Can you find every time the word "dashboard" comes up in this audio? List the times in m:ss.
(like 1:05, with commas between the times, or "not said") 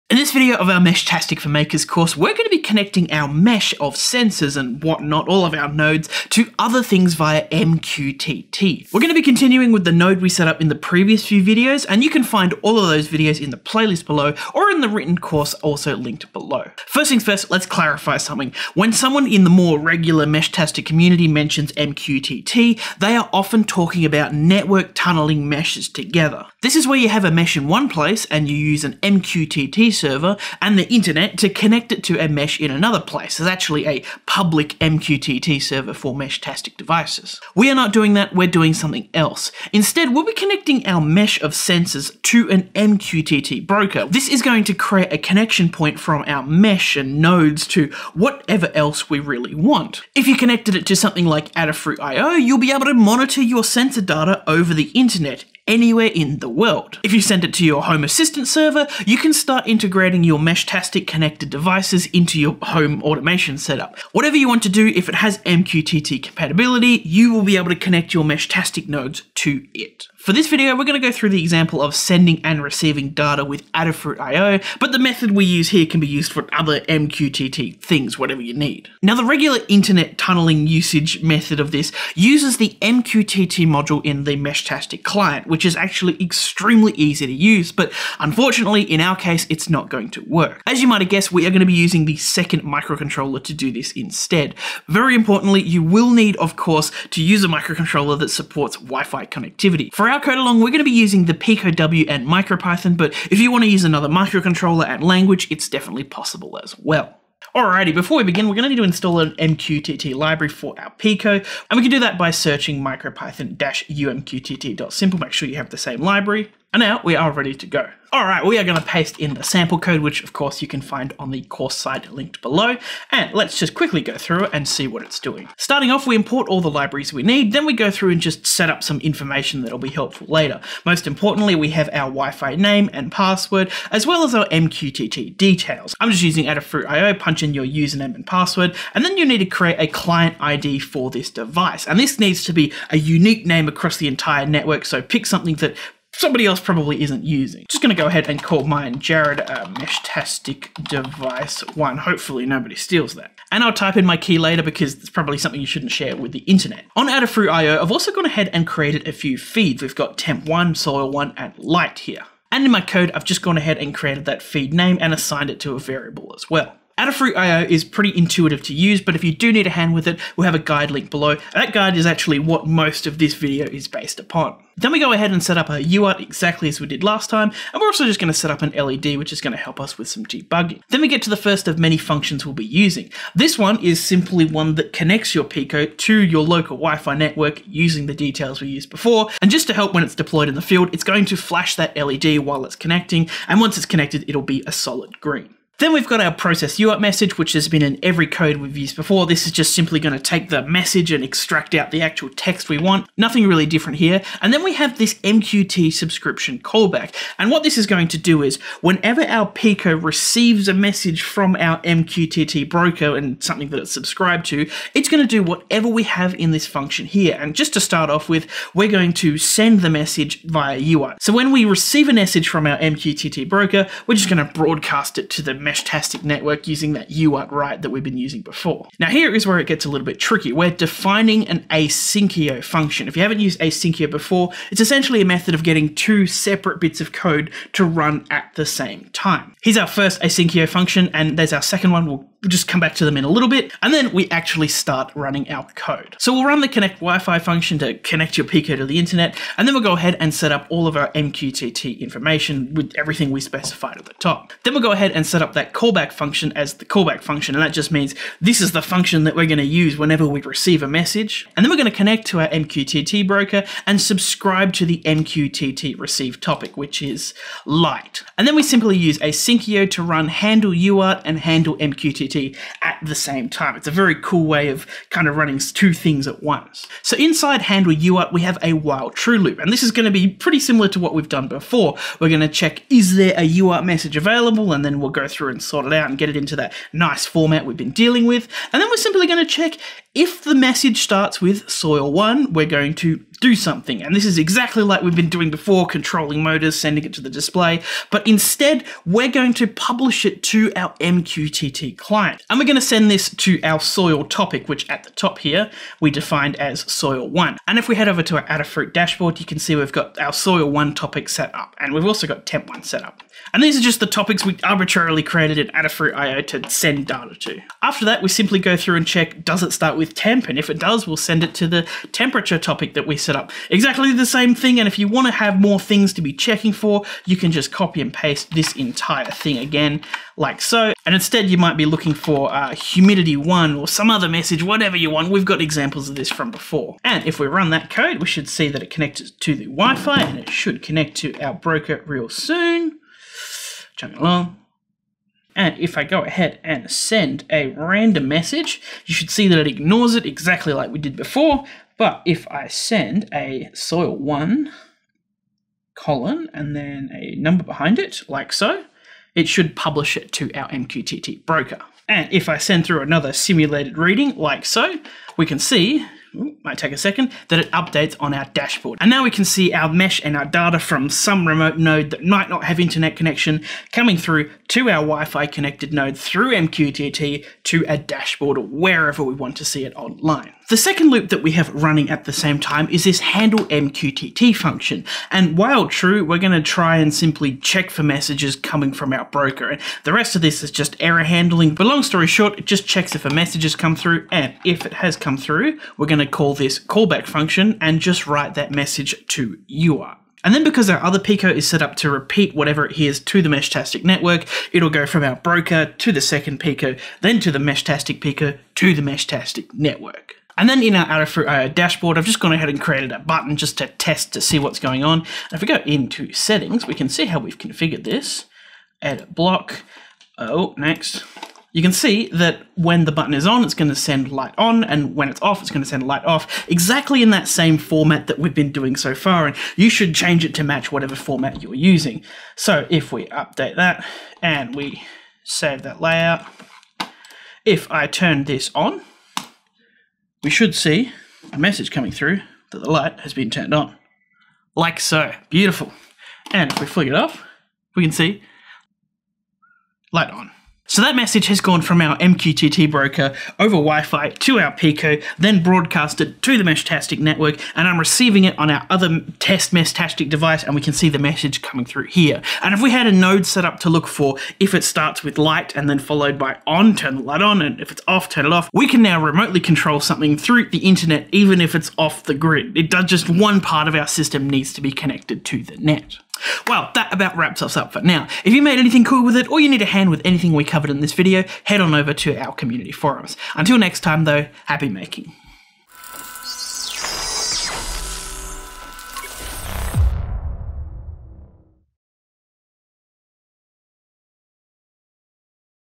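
5:08, 6:08, 6:17, 6:51.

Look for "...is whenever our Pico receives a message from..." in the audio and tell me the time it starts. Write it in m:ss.
3:28.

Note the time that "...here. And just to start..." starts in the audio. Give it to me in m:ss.
3:37.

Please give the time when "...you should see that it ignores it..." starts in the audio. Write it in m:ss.
5:49.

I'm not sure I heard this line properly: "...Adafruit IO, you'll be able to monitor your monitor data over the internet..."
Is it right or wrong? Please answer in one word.
wrong.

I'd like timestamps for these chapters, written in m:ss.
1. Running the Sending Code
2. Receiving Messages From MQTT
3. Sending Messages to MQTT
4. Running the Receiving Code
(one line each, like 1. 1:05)
1. 5:37
2. 6:19
3. 1:47
4. 6:50.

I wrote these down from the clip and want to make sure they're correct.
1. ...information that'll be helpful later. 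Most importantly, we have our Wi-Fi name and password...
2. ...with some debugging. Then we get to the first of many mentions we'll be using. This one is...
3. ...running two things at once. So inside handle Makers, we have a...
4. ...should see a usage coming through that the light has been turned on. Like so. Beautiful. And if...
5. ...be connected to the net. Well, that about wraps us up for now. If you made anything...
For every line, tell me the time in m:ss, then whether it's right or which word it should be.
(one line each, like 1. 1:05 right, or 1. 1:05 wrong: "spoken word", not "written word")
1. 2:09 right
2. 2:59 wrong: "functions", not "mentions"
3. 4:35 wrong: "UART", not "Makers"
4. 7:20 wrong: "message", not "usage"
5. 7:54 right.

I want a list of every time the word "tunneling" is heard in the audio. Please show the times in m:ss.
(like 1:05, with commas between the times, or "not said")
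0:24, 1:20.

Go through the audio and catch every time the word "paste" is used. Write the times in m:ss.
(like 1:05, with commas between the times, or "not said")
1:58, 5:28.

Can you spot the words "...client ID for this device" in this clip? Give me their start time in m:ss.
2:19.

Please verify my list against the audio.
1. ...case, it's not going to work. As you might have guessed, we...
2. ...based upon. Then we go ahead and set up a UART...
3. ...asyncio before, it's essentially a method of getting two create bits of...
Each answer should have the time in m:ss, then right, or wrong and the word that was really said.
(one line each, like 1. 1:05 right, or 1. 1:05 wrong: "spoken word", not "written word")
1. 1:29 right
2. 2:53 right
3. 3:53 wrong: "separate", not "create".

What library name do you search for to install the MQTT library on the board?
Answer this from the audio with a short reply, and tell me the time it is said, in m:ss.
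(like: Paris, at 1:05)
micropython-umqtt.simple, at 1:52.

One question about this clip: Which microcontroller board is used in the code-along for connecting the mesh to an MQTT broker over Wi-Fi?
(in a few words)
Pico W.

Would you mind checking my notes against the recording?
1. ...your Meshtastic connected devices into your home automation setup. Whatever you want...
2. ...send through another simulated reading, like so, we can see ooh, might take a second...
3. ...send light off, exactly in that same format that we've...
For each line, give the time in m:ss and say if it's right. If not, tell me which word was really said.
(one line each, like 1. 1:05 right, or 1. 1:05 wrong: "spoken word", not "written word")
1. 1:00 right
2. 6:02 right
3. 7:05 right.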